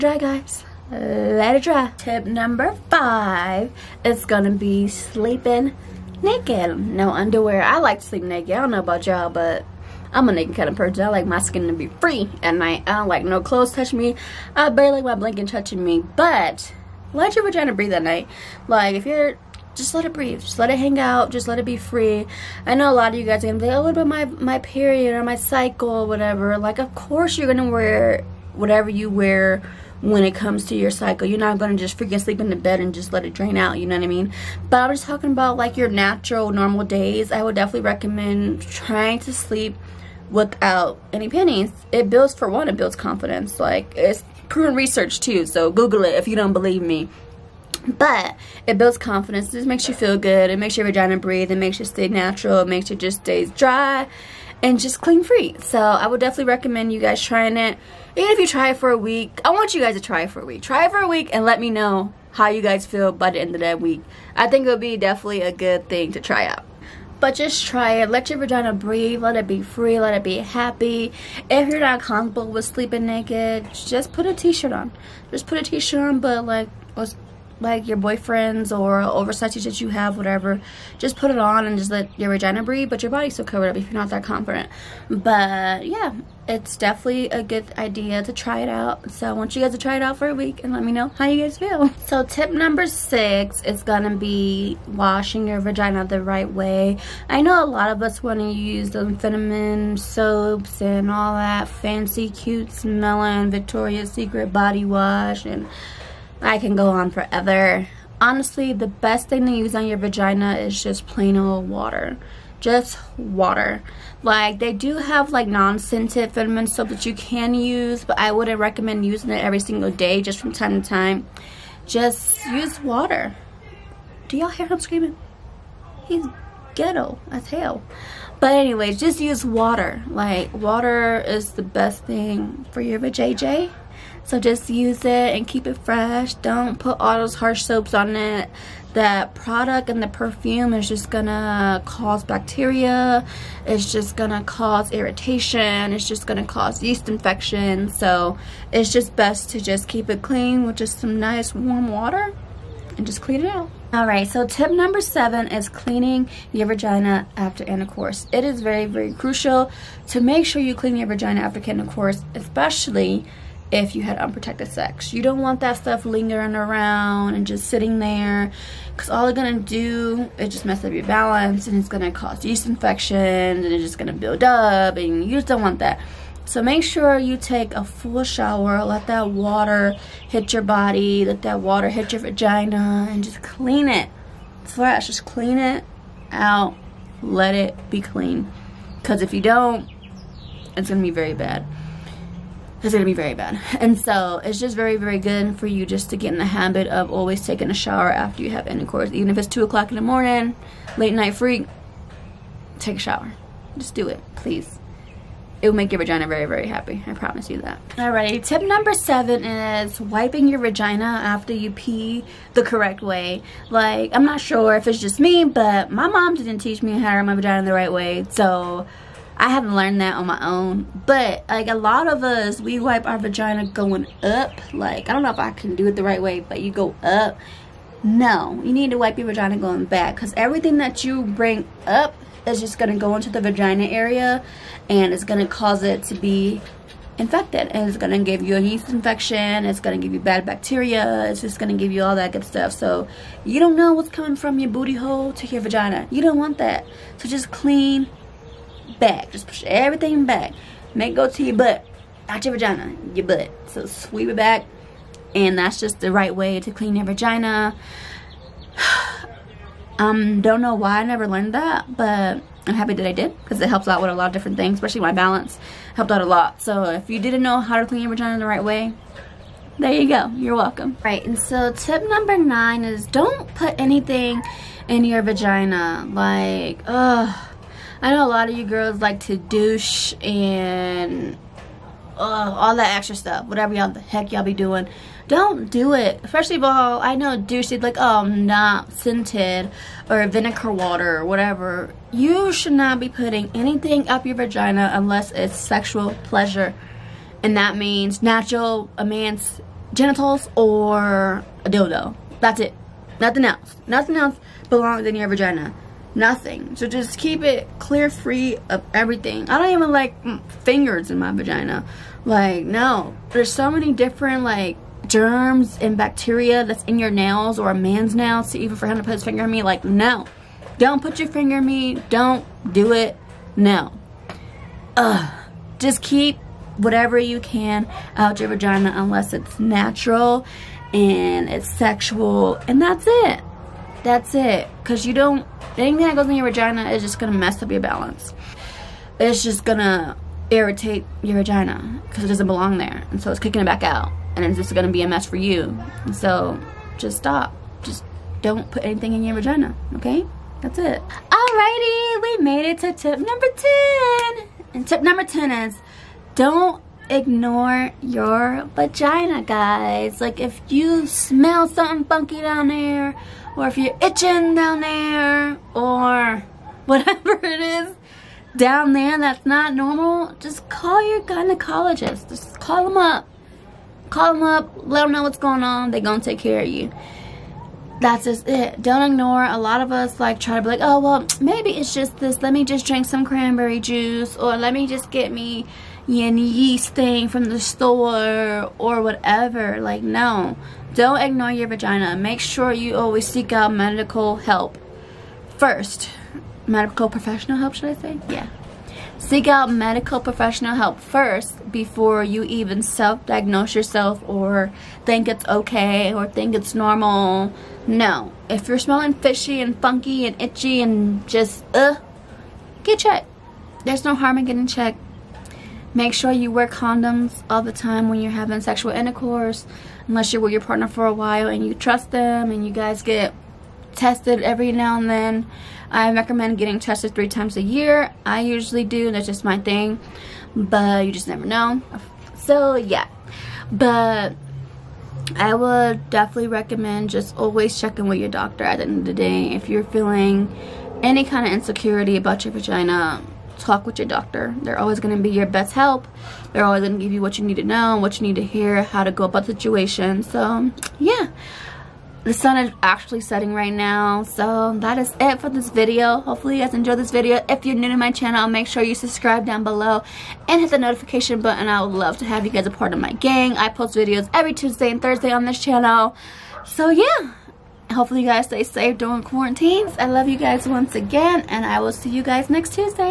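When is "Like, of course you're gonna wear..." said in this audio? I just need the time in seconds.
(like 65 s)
26 s.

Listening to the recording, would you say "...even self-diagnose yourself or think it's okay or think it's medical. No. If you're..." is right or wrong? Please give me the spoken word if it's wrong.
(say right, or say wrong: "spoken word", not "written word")
wrong: "normal", not "medical".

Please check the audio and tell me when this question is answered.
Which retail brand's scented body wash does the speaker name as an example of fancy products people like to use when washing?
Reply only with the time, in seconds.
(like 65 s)
103 s.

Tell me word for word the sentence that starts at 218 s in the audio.
So I haven't learned that on my own.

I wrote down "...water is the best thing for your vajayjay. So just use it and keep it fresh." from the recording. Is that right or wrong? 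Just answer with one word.
right.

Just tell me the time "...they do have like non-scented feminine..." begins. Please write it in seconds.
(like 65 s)
114 s.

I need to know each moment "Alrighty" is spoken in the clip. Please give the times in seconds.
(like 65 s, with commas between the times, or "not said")
207 s, 351 s.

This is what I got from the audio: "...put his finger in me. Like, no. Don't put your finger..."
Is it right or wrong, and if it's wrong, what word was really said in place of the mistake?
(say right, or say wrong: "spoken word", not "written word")
right.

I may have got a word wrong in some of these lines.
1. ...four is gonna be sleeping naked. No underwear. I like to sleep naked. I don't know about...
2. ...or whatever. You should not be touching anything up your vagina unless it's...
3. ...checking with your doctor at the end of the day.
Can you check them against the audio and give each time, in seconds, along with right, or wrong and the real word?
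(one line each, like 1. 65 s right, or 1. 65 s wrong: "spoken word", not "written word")
1. 2 s wrong: "five", not "four"
2. 291 s wrong: "putting", not "touching"
3. 437 s right.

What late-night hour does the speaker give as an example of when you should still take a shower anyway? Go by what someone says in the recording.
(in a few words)
2 o'clock in the morning.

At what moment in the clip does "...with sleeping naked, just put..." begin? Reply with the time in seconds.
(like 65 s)
72 s.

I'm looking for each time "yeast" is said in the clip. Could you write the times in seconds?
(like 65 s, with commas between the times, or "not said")
146 s, 172 s, 238 s, 386 s.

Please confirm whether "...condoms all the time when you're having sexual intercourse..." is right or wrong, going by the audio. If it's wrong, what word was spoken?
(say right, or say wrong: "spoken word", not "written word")
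right.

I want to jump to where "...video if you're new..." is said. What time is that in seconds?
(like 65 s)
457 s.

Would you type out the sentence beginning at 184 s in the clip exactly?
Fresh, just clean it out, let it be clean.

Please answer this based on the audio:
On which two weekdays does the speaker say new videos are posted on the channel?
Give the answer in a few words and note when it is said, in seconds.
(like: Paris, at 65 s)
Tuesday and Thursday, at 464 s.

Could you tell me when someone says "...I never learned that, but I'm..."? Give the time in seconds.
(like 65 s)
260 s.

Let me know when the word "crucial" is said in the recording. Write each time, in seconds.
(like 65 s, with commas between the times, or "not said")
159 s.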